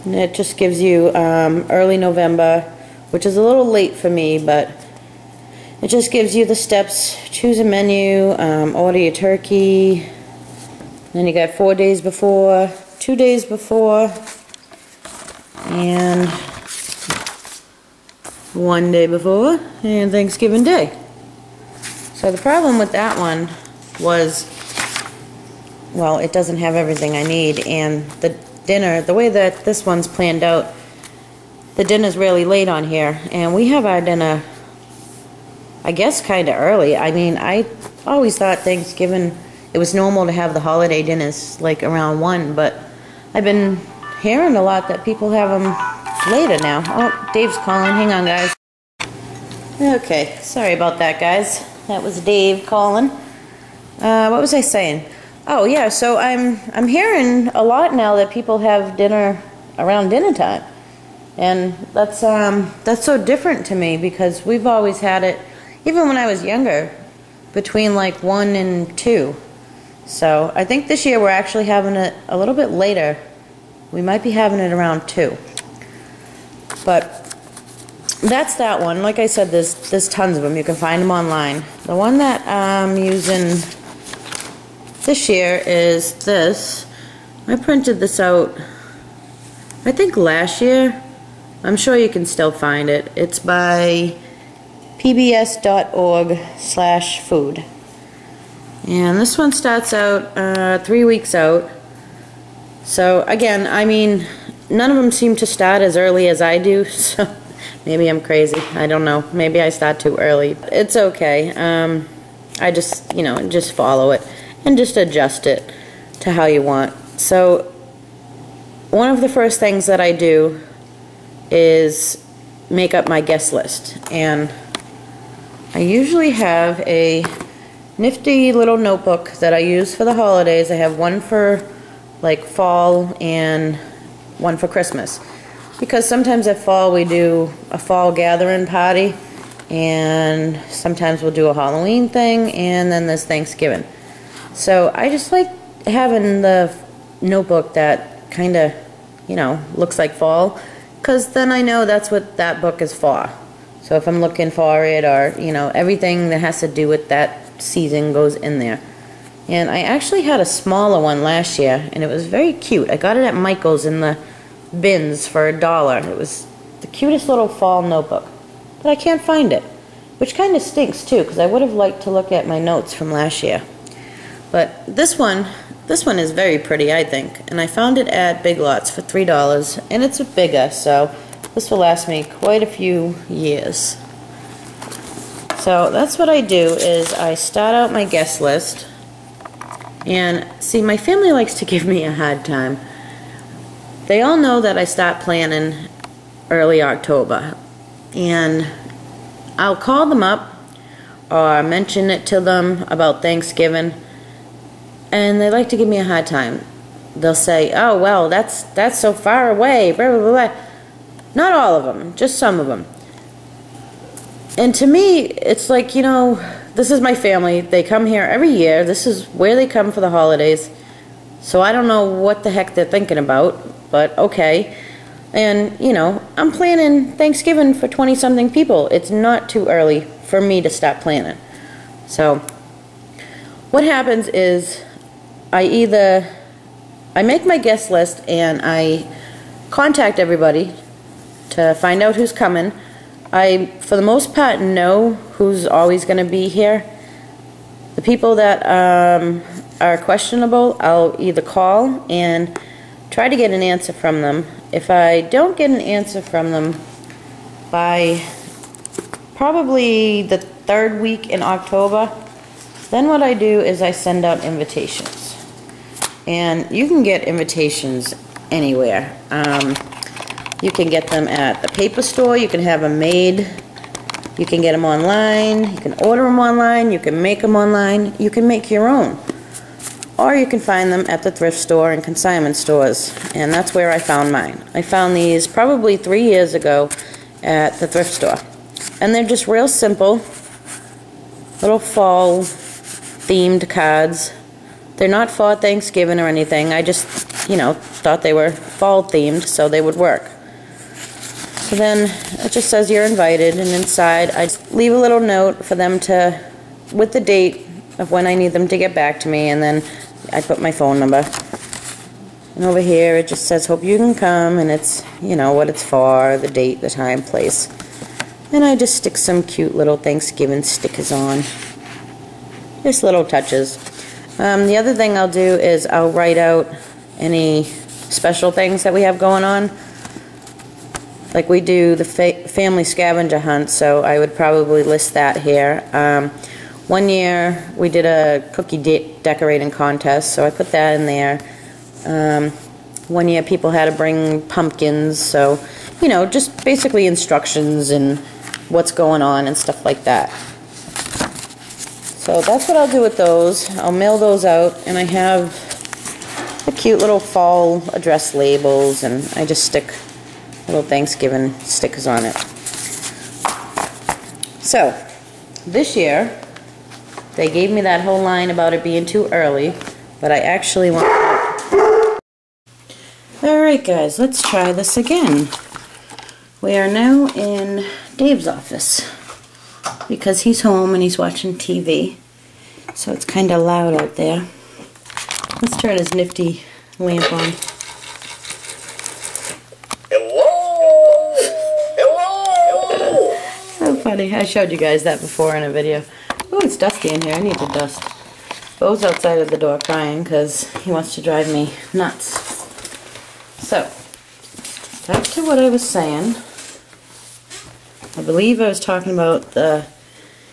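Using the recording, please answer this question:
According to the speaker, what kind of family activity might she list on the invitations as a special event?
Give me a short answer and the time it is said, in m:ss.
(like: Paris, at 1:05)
family scavenger hunt, at 5:32.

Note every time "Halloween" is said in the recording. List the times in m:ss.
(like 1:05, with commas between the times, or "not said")
2:21.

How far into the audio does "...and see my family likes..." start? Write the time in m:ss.
3:10.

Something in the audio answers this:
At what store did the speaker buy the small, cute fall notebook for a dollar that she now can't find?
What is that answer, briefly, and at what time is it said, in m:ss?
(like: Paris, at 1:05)
Michael's, at 2:43.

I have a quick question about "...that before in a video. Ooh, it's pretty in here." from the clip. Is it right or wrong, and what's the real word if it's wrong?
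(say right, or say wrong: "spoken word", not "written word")
wrong: "dusty", not "pretty".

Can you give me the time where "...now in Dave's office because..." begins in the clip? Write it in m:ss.
6:16.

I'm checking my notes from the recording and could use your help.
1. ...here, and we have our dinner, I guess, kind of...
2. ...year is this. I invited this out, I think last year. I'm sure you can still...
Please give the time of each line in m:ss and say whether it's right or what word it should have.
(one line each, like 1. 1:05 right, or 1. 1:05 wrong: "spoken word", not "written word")
1. 0:32 right
2. 1:25 wrong: "printed", not "invited".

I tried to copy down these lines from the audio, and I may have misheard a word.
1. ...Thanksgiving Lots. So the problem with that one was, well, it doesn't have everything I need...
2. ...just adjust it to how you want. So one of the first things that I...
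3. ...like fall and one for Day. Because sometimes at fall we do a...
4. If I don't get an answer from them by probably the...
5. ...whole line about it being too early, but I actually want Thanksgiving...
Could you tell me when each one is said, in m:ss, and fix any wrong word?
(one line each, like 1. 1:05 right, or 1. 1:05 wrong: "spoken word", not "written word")
1. 0:20 wrong: "Day", not "Lots"
2. 1:54 right
3. 2:12 wrong: "Christmas", not "Day"
4. 4:14 right
5. 6:08 wrong: "Alright", not "Thanksgiving".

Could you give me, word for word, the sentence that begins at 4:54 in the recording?
They're not for Thanksgiving or anything.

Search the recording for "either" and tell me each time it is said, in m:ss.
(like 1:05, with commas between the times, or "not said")
3:55, 4:11.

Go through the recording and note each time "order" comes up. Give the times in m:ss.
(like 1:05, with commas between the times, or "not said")
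0:08, 4:36.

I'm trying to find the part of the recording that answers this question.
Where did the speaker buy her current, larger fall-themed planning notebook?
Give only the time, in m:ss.
2:58.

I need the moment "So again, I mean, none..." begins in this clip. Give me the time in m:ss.
1:42.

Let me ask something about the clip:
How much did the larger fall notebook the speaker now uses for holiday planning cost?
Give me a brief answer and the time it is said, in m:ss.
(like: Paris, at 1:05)
$3, at 2:59.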